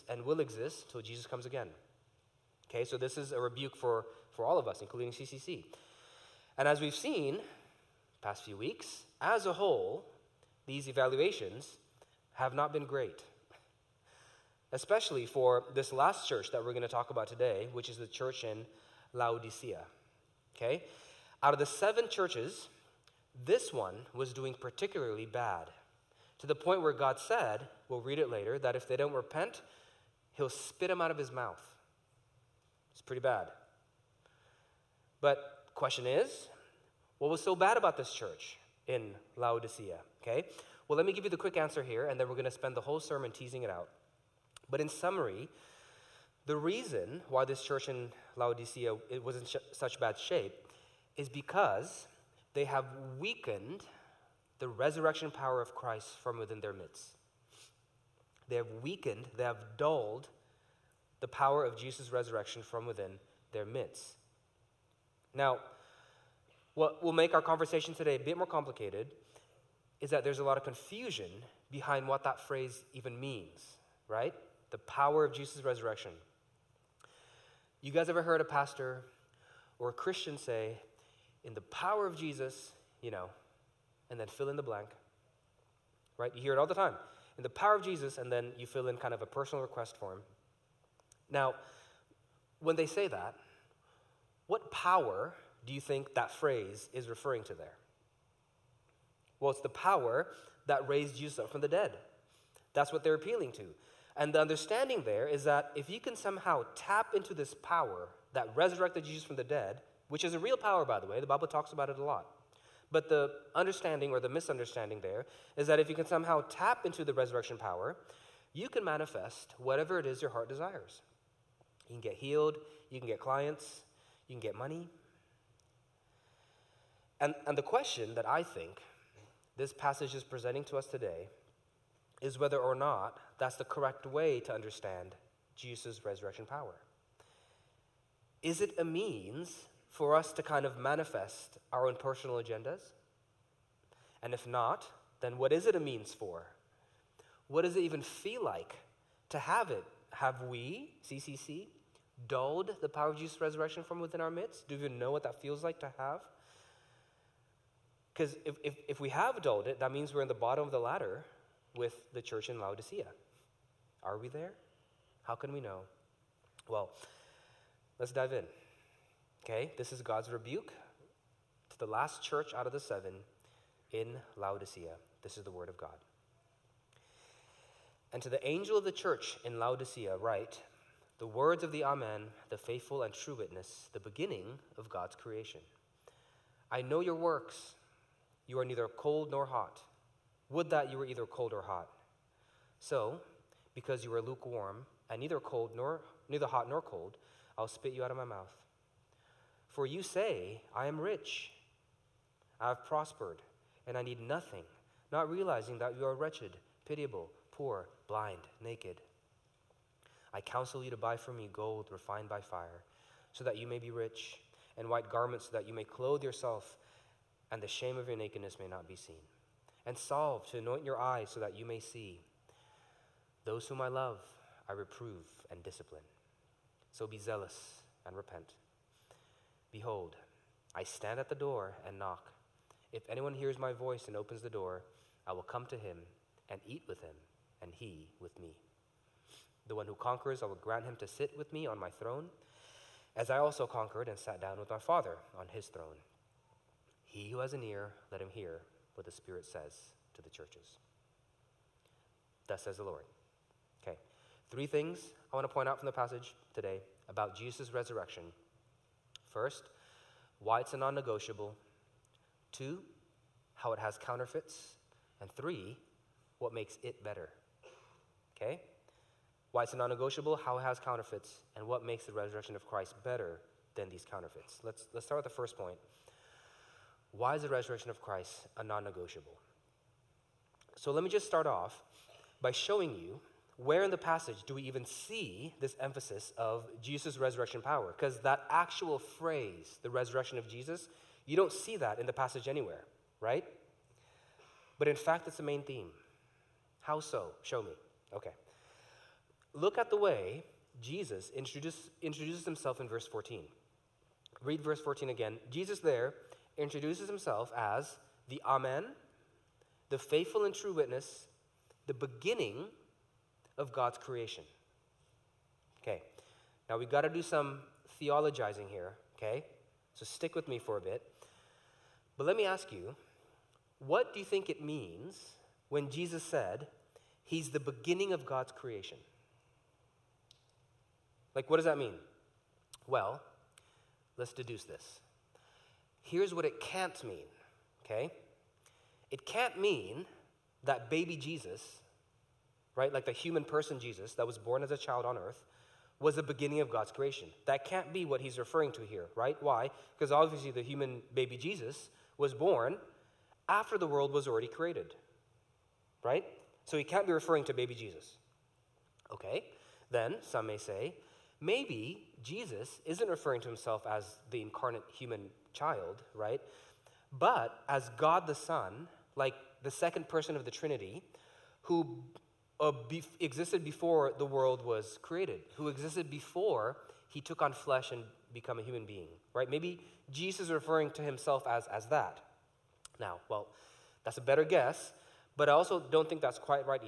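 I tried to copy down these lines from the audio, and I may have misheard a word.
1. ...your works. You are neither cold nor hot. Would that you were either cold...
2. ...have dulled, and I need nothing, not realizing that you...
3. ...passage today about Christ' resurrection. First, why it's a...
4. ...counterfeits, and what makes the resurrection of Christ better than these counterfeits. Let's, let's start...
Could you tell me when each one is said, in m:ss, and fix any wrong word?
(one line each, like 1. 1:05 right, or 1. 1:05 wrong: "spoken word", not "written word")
1. 3:07 right
2. 3:22 wrong: "prospered", not "dulled"
3. 4:15 wrong: "Jesus", not "Christ"
4. 4:30 right.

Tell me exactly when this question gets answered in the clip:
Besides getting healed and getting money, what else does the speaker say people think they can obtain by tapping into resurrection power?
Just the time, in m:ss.
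2:03.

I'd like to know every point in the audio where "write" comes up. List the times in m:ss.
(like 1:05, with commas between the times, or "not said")
3:00.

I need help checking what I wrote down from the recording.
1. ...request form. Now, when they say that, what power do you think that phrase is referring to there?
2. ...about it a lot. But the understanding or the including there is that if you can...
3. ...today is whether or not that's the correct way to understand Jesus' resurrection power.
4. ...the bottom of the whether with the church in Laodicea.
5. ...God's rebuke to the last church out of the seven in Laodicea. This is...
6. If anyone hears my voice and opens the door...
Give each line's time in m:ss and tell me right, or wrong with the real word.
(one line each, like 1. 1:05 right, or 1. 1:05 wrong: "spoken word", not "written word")
1. 1:29 right
2. 1:51 wrong: "misunderstanding", not "including"
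3. 2:10 right
4. 2:40 wrong: "ladder", not "whether"
5. 2:50 right
6. 3:52 right.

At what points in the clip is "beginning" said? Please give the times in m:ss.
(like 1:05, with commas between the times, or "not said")
3:03, 5:11, 5:27, 5:46.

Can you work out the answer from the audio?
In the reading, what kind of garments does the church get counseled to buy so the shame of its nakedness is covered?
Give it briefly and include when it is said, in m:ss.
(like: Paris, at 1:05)
White garments, at 3:34.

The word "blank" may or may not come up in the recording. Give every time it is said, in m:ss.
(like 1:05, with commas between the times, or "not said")
1:24.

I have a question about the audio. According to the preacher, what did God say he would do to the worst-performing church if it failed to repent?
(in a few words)
Spit them out of his mouth.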